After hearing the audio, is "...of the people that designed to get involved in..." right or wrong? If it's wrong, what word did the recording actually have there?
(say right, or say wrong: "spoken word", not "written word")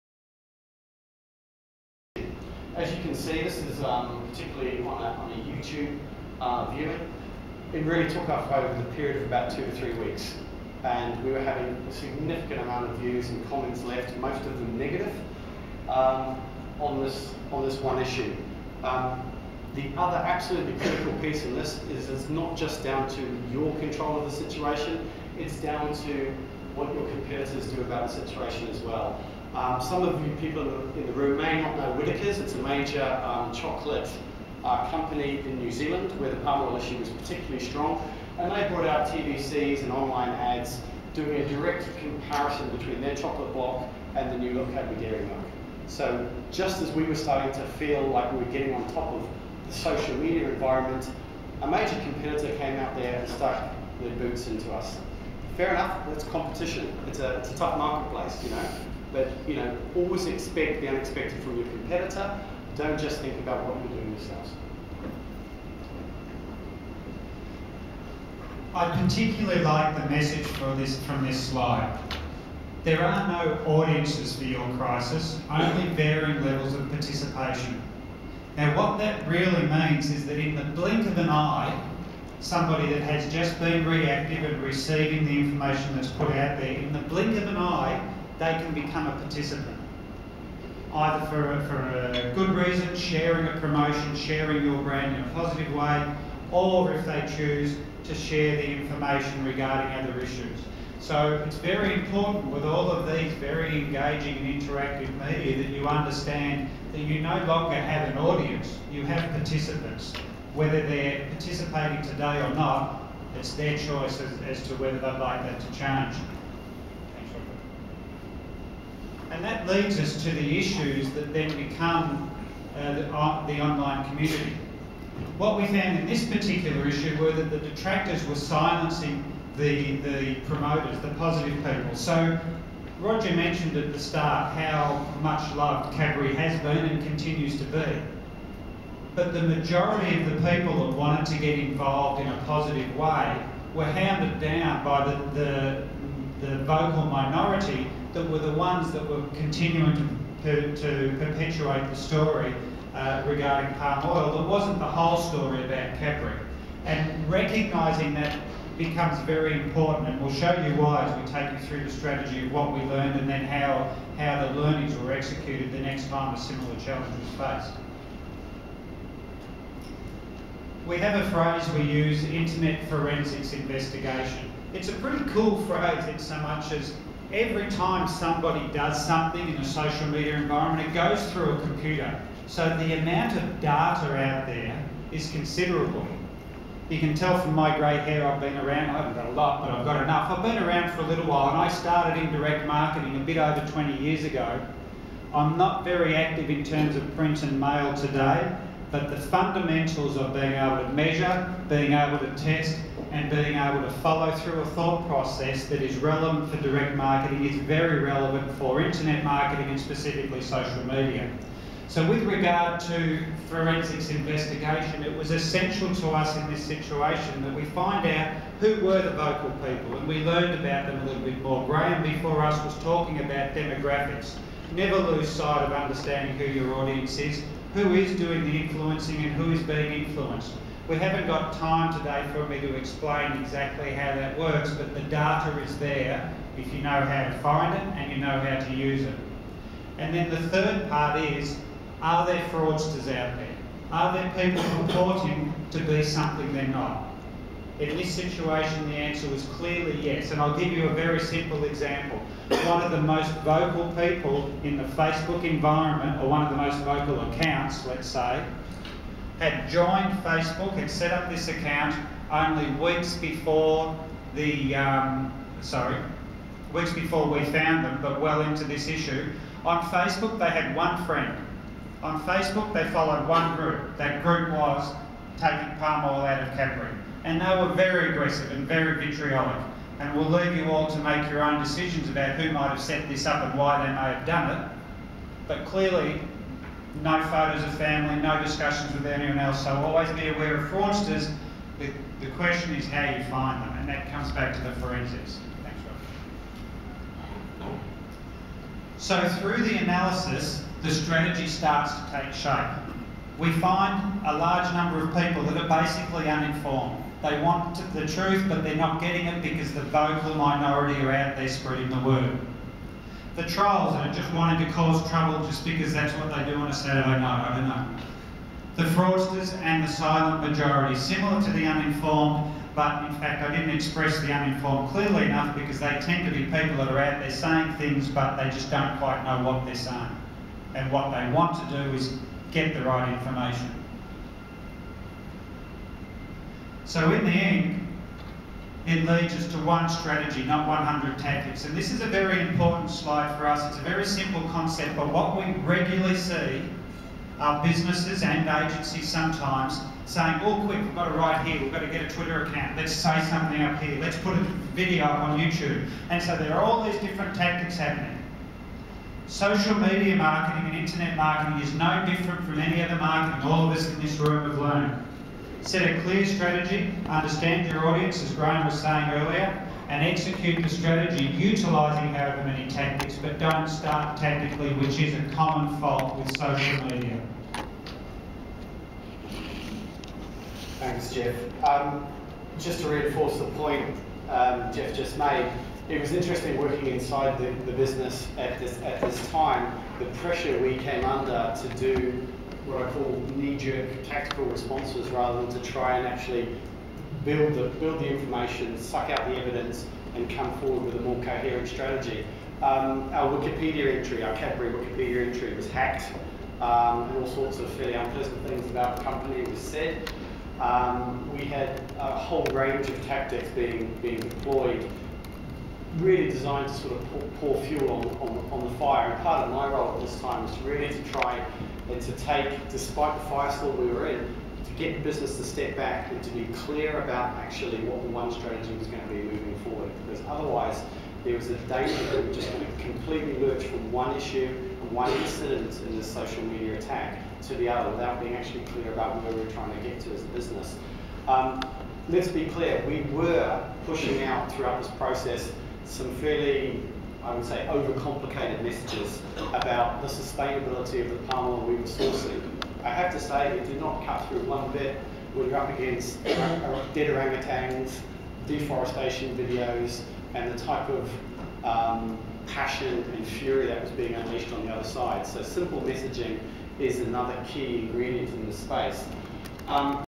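wrong: "wanted", not "designed".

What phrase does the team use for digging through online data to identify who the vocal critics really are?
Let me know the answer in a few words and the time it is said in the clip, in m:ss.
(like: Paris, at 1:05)
Internet forensics investigation, at 2:52.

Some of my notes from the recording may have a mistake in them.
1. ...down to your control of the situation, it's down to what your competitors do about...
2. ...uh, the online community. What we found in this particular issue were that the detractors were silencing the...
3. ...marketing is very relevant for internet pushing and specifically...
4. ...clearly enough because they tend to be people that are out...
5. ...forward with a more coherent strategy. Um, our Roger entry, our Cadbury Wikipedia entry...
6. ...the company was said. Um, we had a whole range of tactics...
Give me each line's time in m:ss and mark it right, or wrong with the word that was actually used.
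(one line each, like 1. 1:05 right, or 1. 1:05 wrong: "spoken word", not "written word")
1. 0:22 right
2. 2:03 right
3. 3:26 wrong: "marketing", not "pushing"
4. 5:24 right
5. 6:40 wrong: "Wikipedia", not "Roger"
6. 6:48 right.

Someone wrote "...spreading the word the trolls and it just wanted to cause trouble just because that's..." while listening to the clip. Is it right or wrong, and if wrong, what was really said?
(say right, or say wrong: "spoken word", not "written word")
right.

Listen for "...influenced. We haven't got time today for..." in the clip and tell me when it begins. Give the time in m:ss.
3:50.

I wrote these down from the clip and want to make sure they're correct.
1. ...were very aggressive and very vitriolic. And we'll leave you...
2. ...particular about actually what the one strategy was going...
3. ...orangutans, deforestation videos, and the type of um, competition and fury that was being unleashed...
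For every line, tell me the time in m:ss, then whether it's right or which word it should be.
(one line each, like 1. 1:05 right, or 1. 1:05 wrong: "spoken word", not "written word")
1. 4:37 right
2. 7:06 wrong: "clear", not "particular"
3. 7:37 wrong: "passion", not "competition".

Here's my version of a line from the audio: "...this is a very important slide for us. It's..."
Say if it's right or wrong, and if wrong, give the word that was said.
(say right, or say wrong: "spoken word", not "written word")
right.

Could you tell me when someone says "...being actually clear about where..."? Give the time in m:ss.
7:18.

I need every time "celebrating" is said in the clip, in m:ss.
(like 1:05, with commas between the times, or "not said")
not said.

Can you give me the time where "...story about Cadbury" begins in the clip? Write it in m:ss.
2:35.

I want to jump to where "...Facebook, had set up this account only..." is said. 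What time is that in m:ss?
4:20.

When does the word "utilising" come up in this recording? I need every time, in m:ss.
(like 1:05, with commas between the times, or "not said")
6:11.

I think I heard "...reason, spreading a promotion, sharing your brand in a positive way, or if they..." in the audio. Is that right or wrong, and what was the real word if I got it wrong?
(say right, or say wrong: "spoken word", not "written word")
wrong: "sharing", not "spreading".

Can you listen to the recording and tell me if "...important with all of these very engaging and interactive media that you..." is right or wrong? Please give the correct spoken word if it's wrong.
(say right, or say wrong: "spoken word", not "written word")
right.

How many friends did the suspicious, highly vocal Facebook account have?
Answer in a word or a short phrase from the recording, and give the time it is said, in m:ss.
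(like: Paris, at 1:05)
1, at 4:30.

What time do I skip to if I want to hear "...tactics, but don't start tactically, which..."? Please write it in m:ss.
6:12.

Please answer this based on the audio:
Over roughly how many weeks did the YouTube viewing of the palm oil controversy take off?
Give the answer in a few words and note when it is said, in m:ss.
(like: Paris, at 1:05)
2 to 3 weeks, at 0:09.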